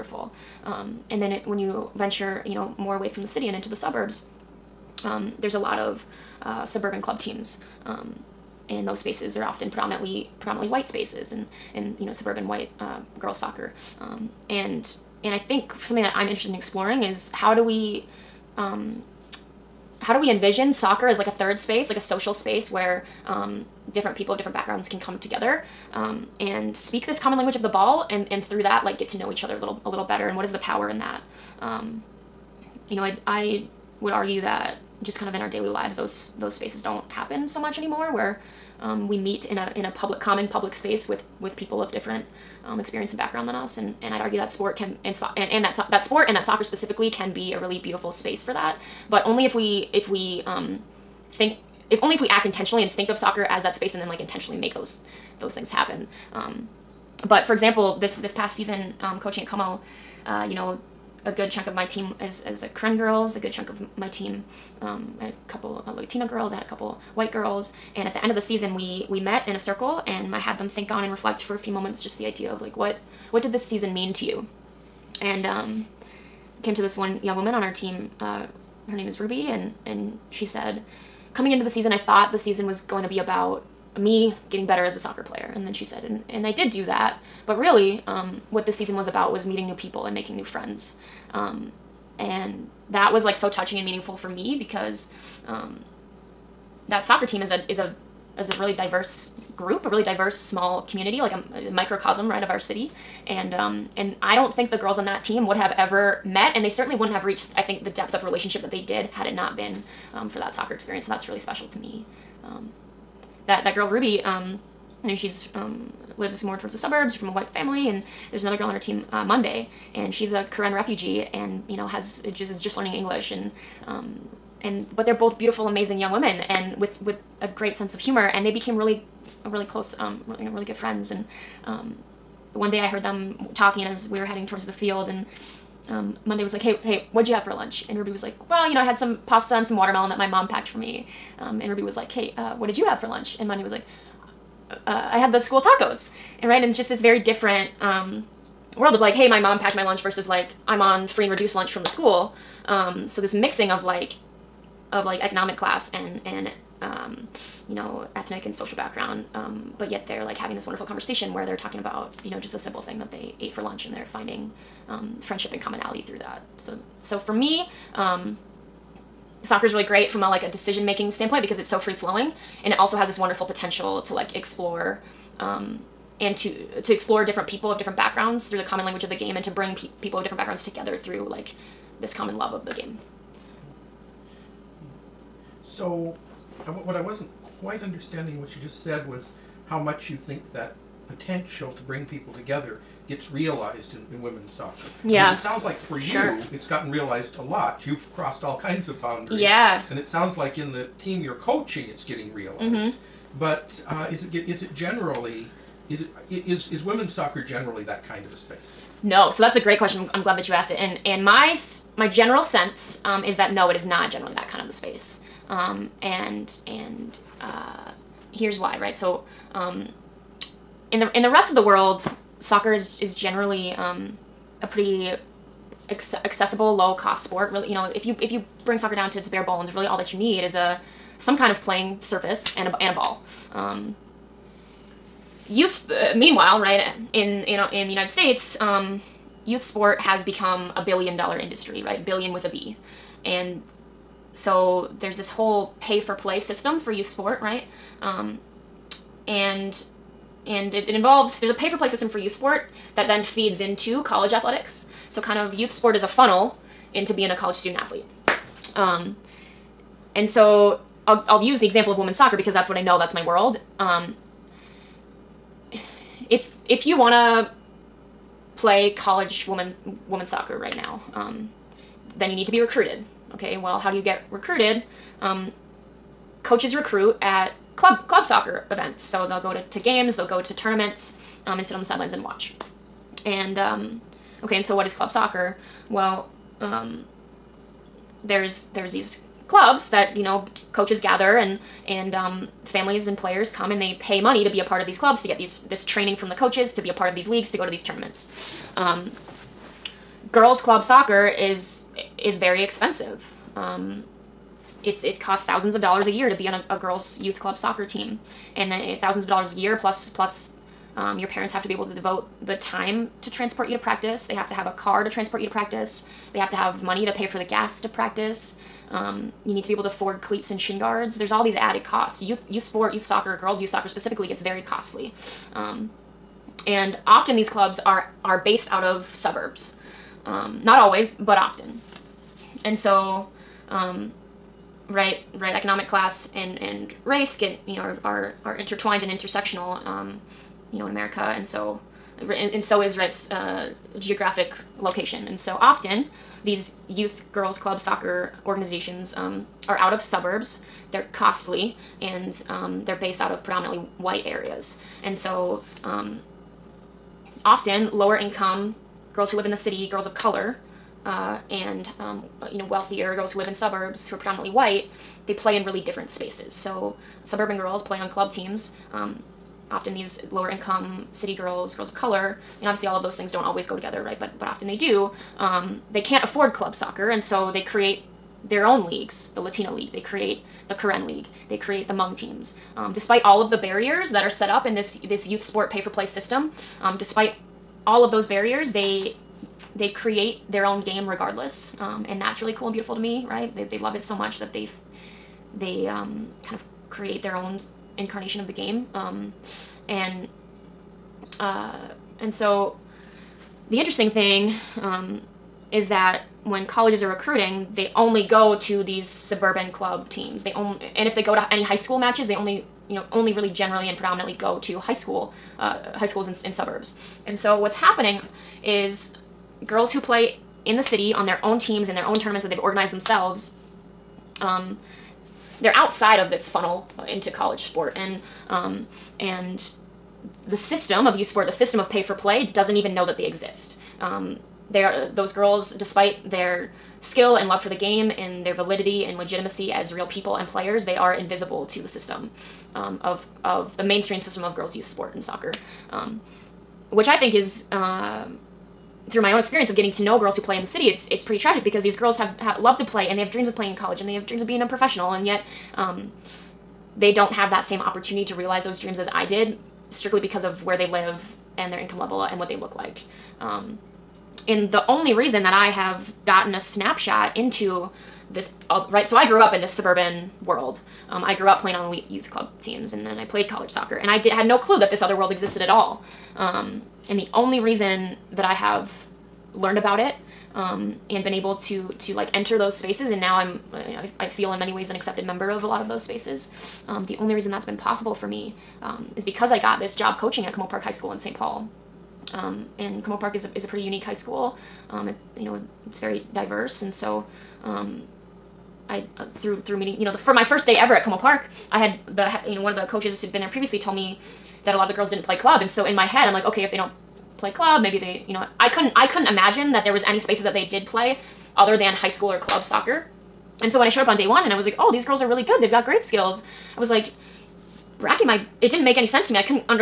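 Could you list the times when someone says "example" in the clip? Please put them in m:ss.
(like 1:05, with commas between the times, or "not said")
0:57, 4:21.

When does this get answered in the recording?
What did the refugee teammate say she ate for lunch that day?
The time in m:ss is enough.
2:25.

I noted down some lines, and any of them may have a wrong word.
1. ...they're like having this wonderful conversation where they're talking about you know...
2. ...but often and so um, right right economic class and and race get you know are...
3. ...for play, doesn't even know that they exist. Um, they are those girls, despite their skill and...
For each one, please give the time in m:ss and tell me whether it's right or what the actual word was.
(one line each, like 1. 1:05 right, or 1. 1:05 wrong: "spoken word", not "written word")
1. 2:40 right
2. 5:31 right
3. 7:12 right.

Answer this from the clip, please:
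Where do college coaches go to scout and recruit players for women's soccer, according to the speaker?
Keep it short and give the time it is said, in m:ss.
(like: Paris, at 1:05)
club soccer events, at 4:38.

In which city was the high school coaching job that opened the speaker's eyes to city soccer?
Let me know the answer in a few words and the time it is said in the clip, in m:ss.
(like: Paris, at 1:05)
St. Paul, at 8:11.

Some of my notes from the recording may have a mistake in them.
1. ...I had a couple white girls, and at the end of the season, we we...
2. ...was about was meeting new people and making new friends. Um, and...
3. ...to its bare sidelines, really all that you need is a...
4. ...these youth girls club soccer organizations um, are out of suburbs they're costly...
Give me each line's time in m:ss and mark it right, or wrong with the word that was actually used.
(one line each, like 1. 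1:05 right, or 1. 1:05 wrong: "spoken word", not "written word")
1. 1:06 right
2. 1:28 right
3. 3:49 wrong: "bones", not "sidelines"
4. 5:46 right.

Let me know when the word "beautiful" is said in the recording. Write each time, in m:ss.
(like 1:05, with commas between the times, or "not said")
0:47, 2:05, 6:32.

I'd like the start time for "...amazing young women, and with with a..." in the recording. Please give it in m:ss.
2:05.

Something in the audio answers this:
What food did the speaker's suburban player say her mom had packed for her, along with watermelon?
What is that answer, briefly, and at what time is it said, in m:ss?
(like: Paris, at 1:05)
pasta, at 2:19.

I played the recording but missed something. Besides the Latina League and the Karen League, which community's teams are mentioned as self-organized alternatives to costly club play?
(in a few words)
Hmong.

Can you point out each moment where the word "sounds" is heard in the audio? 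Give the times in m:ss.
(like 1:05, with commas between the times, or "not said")
3:15, 3:20.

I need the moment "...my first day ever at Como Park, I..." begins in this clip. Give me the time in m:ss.
8:20.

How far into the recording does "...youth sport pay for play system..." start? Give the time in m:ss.
6:25.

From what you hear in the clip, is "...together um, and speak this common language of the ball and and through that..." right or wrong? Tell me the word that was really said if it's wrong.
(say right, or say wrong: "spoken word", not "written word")
right.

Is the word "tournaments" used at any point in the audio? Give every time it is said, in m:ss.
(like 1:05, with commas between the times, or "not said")
4:40, 4:57, 7:02.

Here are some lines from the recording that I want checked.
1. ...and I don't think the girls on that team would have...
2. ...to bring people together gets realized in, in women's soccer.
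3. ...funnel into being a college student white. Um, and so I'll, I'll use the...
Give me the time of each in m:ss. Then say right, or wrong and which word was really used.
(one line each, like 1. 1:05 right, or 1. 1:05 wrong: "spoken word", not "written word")
1. 1:43 right
2. 3:11 right
3. 4:16 wrong: "athlete", not "white".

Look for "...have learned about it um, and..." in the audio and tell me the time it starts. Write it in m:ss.
7:58.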